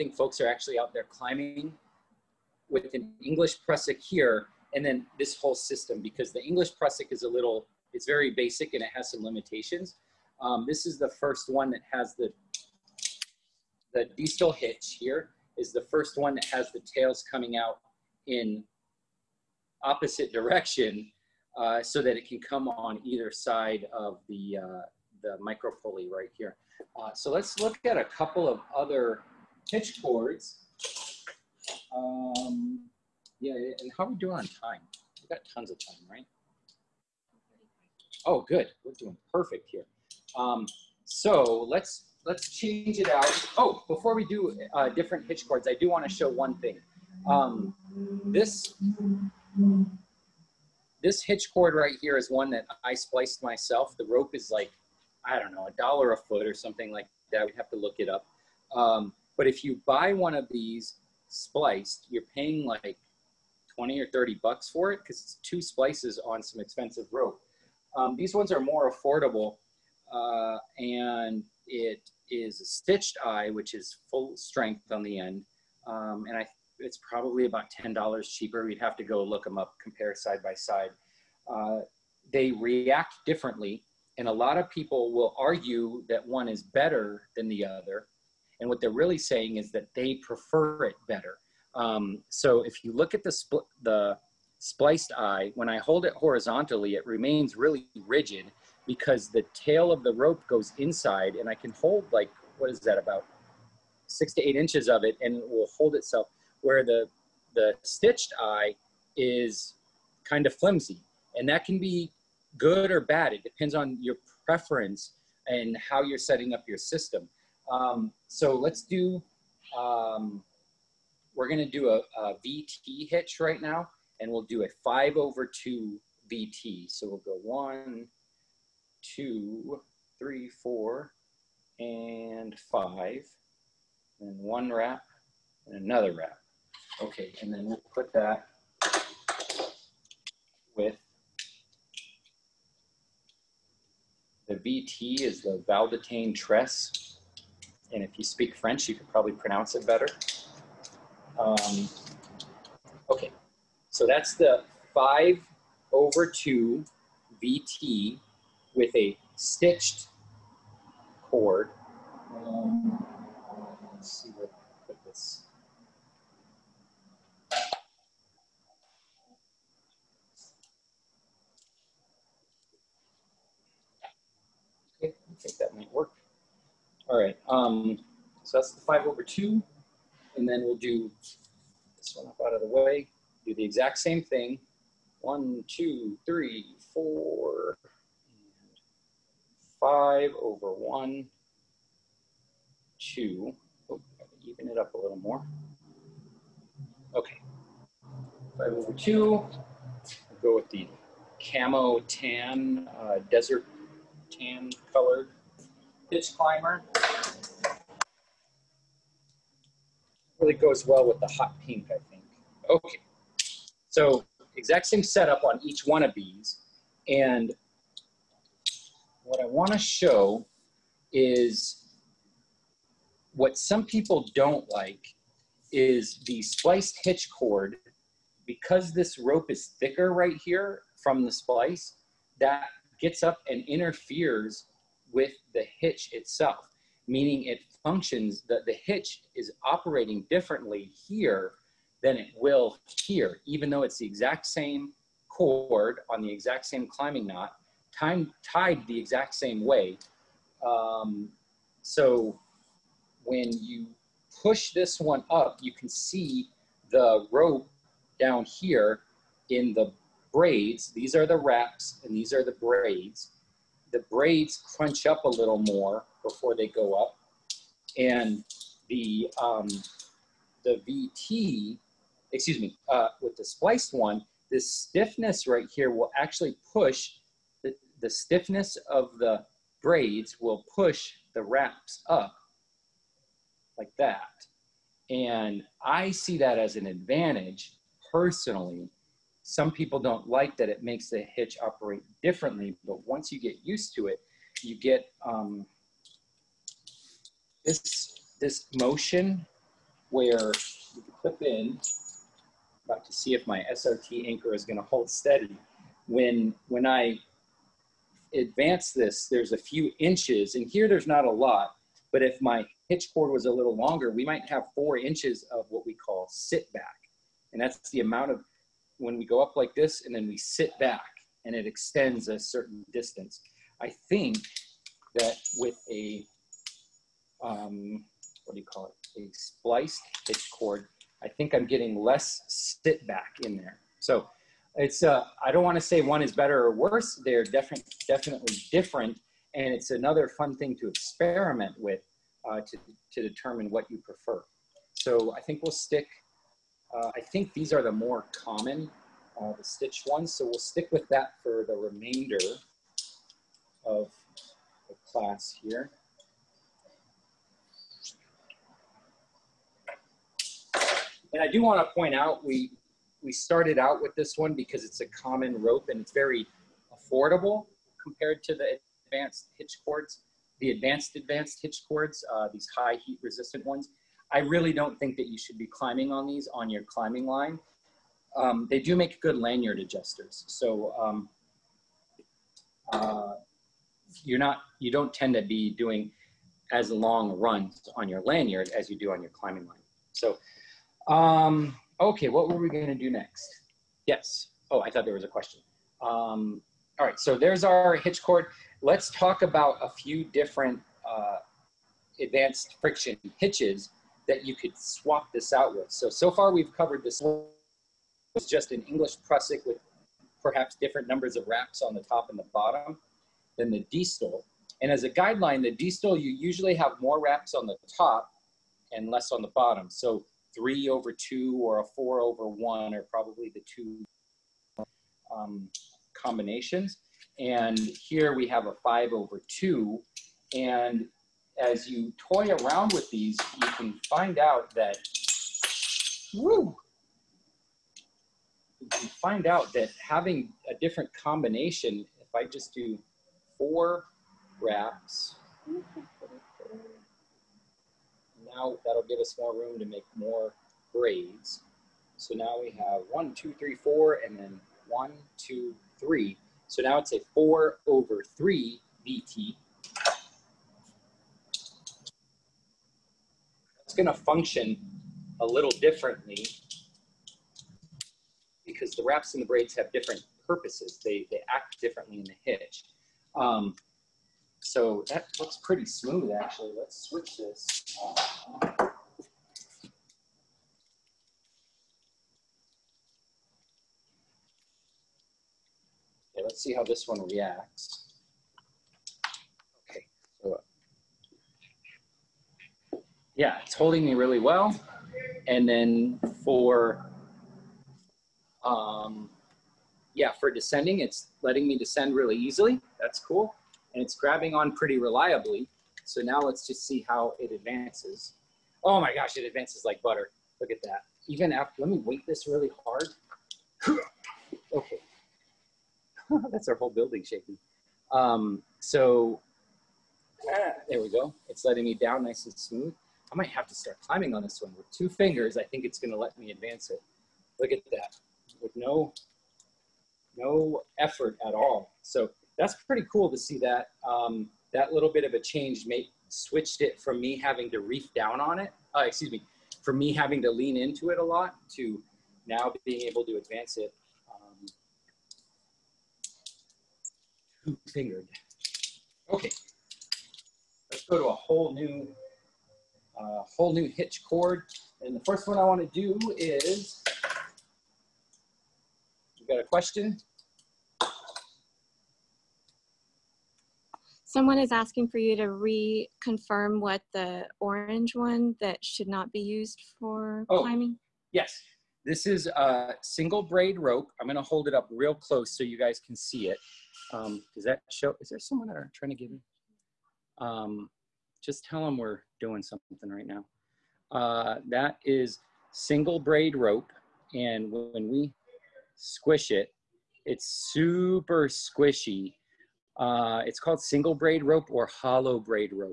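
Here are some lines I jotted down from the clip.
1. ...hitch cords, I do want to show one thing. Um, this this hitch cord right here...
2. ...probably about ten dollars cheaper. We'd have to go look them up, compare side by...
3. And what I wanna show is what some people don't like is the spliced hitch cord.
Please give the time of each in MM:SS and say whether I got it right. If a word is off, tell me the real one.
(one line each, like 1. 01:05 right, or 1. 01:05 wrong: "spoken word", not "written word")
1. 00:45 right
2. 01:17 right
3. 03:37 right.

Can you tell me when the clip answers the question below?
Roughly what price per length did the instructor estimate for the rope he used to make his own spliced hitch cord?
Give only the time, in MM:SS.
00:55.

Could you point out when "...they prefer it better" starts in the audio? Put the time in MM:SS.
01:29.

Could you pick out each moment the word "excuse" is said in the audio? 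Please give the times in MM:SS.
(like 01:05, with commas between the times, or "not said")
04:32, 08:59.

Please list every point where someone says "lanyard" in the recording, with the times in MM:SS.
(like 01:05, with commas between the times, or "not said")
06:19, 06:28.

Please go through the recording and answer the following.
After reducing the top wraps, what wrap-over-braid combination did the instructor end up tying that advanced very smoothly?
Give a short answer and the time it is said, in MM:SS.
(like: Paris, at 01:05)
4 over 3, at 07:37.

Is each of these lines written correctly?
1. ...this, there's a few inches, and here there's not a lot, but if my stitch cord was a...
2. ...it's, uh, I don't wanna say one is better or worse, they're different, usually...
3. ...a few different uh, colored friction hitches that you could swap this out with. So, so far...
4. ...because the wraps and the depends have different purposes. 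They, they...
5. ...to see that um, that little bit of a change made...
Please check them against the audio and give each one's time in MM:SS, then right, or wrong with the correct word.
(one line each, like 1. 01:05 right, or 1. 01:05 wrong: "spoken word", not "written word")
1. 05:08 wrong: "hitch", not "stitch"
2. 05:34 wrong: "definitely", not "usually"
3. 06:39 wrong: "advanced", not "colored"
4. 07:48 wrong: "braids", not "depends"
5. 08:53 right.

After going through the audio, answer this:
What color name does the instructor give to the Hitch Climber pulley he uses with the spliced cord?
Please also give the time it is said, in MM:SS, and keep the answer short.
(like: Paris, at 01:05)
desert tan, at 03:23.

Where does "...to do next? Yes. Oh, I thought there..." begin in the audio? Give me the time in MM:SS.
06:32.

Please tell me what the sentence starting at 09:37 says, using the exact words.
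Um, does that show, is there someone that I'm trying to give me?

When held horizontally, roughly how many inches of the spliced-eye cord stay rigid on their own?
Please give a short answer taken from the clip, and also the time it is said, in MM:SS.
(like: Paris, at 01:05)
6 to 8 inches, at 01:44.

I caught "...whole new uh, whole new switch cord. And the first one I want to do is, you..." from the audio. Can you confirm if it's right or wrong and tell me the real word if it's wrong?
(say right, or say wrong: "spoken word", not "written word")
wrong: "hitch", not "switch".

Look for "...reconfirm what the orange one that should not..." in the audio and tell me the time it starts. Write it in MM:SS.
09:25.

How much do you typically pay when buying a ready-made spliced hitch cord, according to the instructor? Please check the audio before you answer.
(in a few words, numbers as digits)
20 or 30 bucks.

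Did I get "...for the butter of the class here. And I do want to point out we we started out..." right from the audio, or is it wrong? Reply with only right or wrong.
wrong.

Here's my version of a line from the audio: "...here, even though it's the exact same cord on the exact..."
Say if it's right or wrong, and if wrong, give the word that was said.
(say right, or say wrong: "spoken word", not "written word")
right.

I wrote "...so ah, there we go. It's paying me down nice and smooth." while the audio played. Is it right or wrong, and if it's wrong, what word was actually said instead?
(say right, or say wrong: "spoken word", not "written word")
wrong: "letting", not "paying".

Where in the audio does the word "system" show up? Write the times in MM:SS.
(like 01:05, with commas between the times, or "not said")
00:05, 01:56.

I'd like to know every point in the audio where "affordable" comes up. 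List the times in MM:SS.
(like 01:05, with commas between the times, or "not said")
01:08, 06:06.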